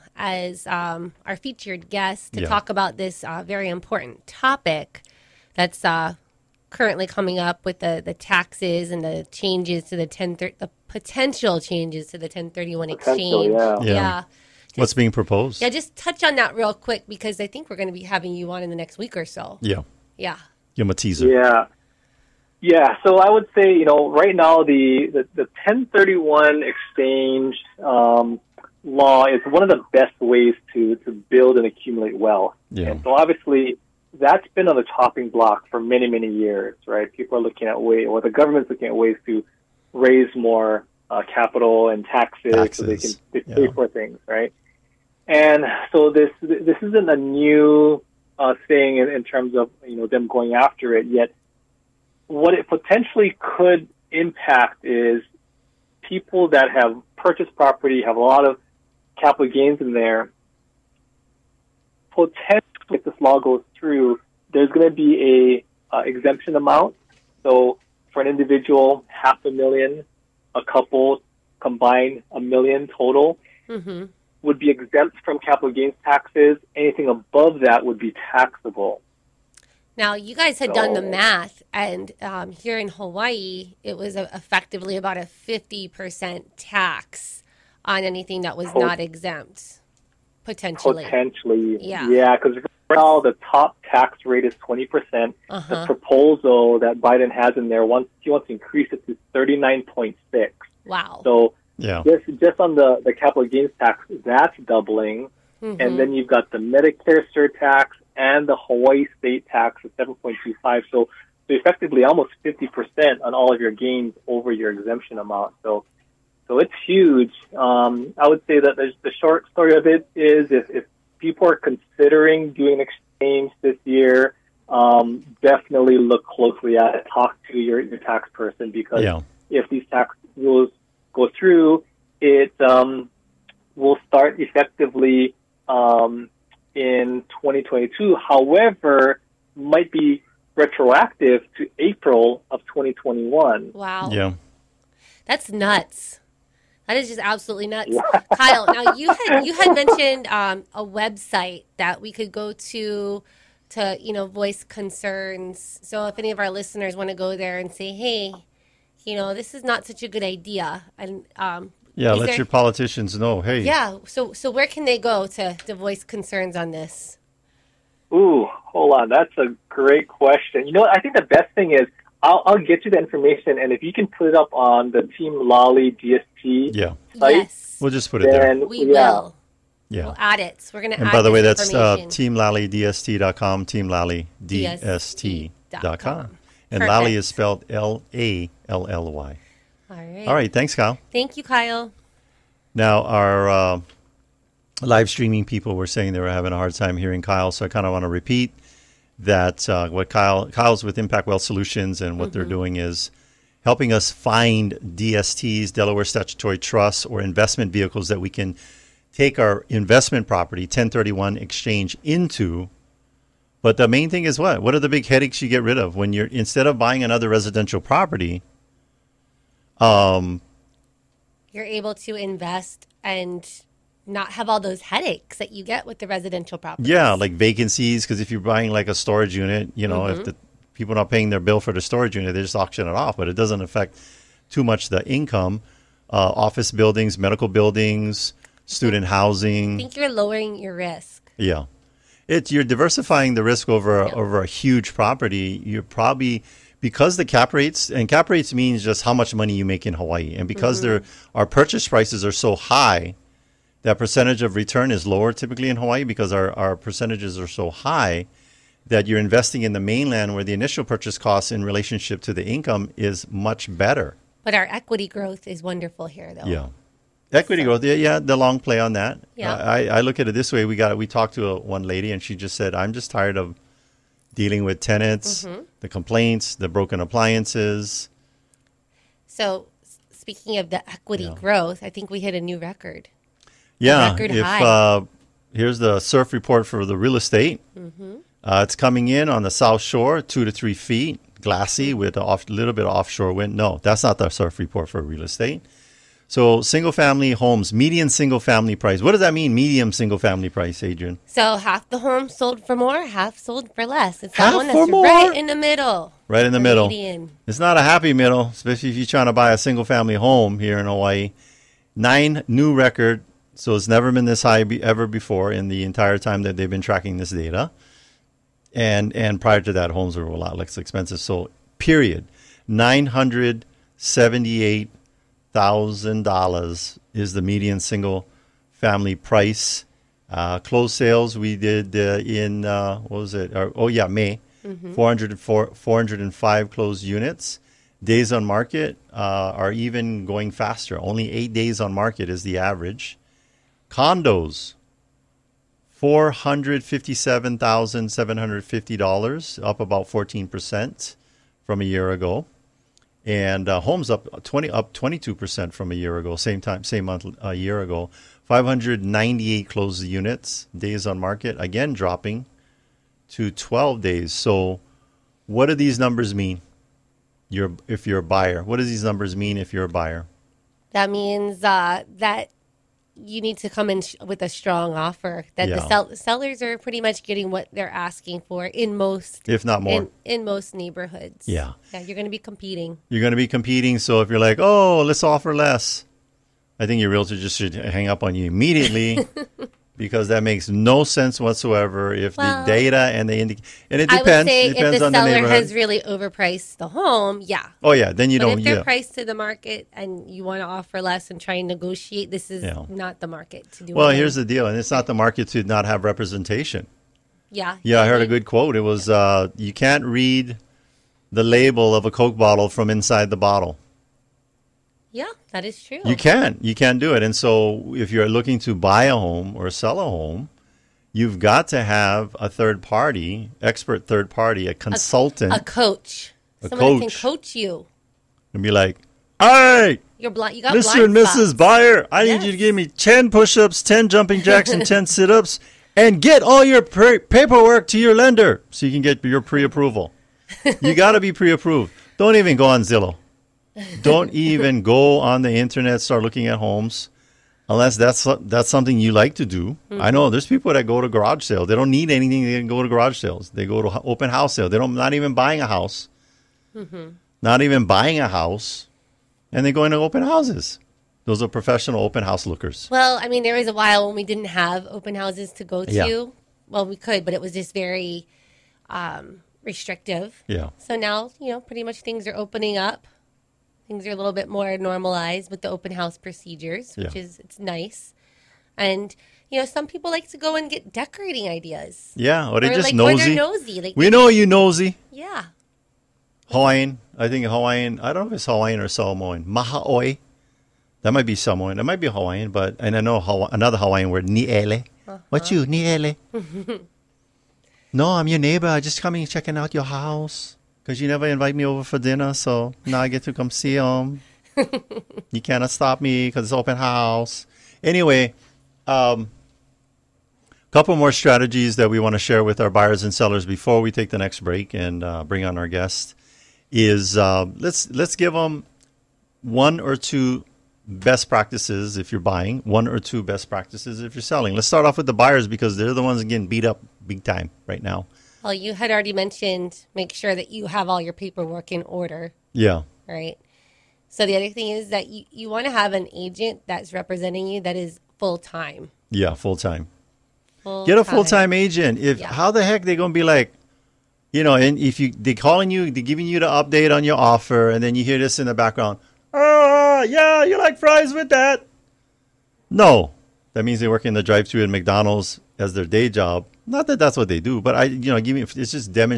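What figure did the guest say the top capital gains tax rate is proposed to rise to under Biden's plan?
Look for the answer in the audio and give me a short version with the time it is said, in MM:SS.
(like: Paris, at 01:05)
39.6, at 01:39.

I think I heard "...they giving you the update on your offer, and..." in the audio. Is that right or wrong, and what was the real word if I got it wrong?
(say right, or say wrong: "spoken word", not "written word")
right.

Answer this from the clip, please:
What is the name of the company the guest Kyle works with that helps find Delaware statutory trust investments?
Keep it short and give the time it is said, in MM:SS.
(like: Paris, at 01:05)
Impact Wealth Solutions, at 03:20.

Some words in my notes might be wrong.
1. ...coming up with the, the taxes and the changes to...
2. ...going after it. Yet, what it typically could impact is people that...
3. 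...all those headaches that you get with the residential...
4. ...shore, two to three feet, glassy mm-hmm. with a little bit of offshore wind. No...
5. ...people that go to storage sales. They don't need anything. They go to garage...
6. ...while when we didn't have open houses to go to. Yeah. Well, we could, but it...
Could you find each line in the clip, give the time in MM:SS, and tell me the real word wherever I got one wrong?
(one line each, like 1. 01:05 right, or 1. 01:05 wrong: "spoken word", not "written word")
1. 00:07 right
2. 00:50 wrong: "potentially", not "typically"
3. 03:44 right
4. 04:49 right
5. 07:30 wrong: "garage", not "storage"
6. 07:43 right.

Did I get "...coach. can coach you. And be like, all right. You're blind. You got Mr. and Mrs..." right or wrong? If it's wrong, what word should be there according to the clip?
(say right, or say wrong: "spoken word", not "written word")
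right.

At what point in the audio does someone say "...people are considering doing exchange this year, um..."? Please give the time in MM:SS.
02:01.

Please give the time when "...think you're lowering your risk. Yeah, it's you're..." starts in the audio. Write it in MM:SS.
03:59.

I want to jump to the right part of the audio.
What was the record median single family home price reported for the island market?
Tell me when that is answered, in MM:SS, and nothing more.
05:22.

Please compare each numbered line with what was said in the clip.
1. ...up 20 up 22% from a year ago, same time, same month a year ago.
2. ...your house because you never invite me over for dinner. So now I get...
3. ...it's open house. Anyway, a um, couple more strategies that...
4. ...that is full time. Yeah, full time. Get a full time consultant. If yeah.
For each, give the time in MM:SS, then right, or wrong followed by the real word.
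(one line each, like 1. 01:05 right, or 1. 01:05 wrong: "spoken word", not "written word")
1. 05:54 right
2. 08:19 right
3. 08:26 right
4. 08:57 wrong: "agent", not "consultant".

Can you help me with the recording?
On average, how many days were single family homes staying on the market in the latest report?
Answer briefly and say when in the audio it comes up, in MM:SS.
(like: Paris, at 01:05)
8, at 05:41.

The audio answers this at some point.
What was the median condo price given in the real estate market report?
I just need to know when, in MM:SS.
05:46.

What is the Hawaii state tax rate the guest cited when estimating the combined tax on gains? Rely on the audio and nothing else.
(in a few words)
7.25.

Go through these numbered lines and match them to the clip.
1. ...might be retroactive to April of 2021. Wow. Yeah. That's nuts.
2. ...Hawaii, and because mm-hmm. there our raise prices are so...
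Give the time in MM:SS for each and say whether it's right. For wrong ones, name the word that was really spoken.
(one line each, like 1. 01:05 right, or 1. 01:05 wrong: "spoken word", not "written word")
1. 02:19 right
2. 04:09 wrong: "purchase", not "raise".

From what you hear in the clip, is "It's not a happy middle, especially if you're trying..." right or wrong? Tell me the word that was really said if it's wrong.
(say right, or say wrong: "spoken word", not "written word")
right.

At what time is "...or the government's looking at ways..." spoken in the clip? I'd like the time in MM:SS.
00:38.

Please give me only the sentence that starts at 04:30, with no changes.
We got we talked to a, one lady, and she just said, "I'm just tired of dealing with tenants, mm-hmm.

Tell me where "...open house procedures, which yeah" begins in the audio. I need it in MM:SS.
07:55.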